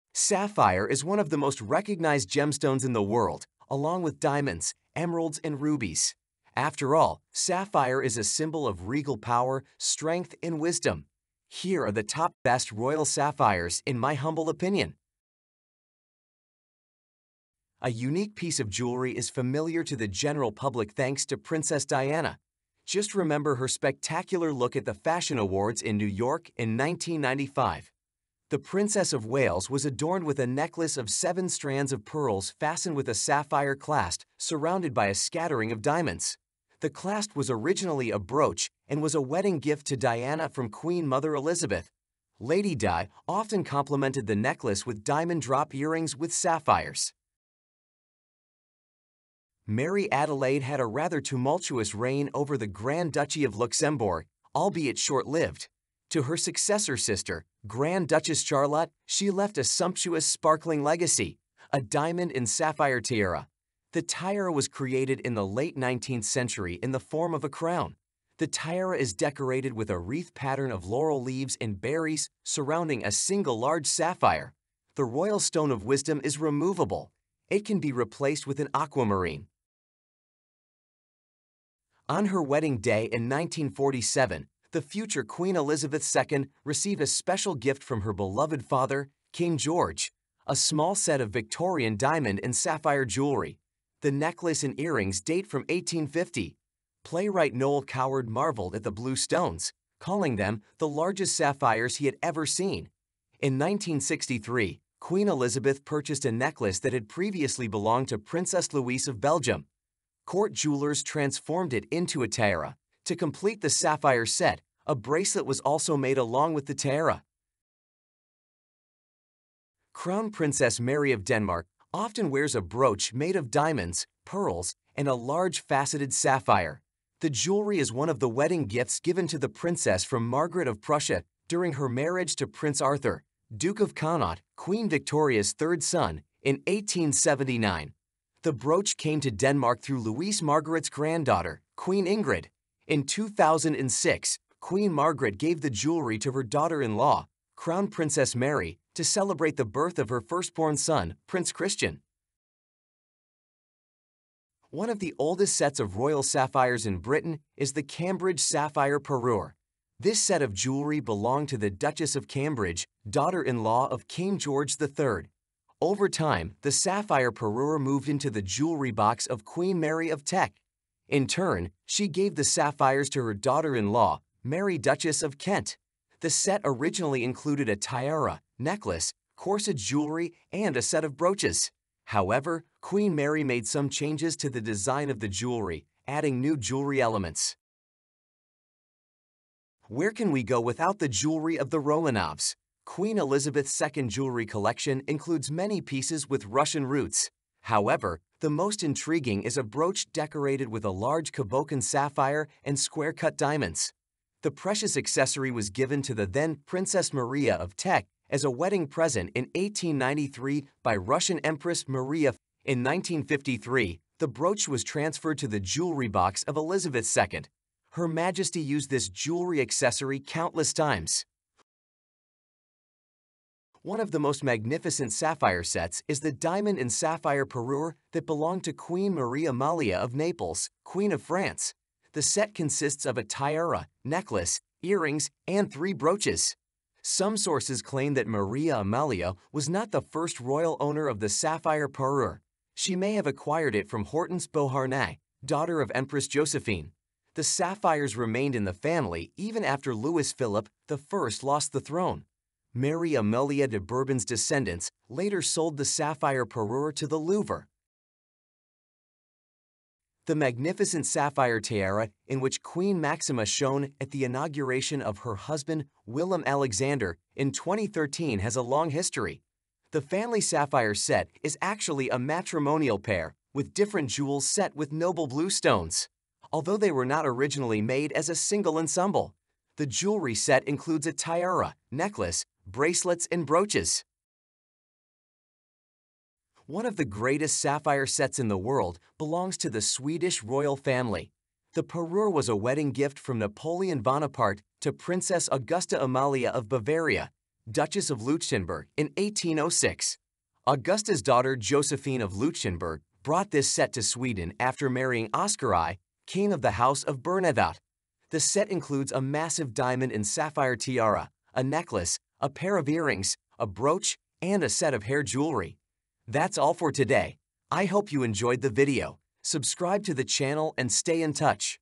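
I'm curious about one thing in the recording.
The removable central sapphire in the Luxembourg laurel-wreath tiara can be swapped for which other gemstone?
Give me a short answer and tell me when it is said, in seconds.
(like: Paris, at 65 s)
aquamarine, at 78 s.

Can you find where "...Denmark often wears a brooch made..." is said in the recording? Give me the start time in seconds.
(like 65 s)
121 s.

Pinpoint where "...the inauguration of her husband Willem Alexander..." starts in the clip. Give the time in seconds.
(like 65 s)
264 s.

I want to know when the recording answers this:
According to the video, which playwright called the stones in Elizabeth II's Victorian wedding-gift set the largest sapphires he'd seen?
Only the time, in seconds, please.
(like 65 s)
97 s.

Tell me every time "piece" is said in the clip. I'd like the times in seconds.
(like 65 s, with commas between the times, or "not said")
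18 s, 195 s.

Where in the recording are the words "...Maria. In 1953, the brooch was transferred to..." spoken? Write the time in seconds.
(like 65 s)
211 s.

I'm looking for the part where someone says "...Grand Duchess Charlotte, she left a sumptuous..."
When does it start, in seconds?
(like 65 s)
57 s.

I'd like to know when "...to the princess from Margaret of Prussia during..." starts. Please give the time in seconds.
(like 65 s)
129 s.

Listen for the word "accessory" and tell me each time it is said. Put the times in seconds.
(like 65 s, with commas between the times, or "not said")
204 s, 219 s.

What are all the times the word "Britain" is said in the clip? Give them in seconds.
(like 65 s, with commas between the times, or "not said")
156 s.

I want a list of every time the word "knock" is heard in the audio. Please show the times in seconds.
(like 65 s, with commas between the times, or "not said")
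not said.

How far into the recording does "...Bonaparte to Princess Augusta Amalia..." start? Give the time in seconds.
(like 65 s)
294 s.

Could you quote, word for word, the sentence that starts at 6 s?
After all, sapphire is a symbol of regal power, strength, and wisdom.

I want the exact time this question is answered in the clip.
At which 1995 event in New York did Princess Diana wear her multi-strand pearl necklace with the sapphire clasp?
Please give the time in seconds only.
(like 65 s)
24 s.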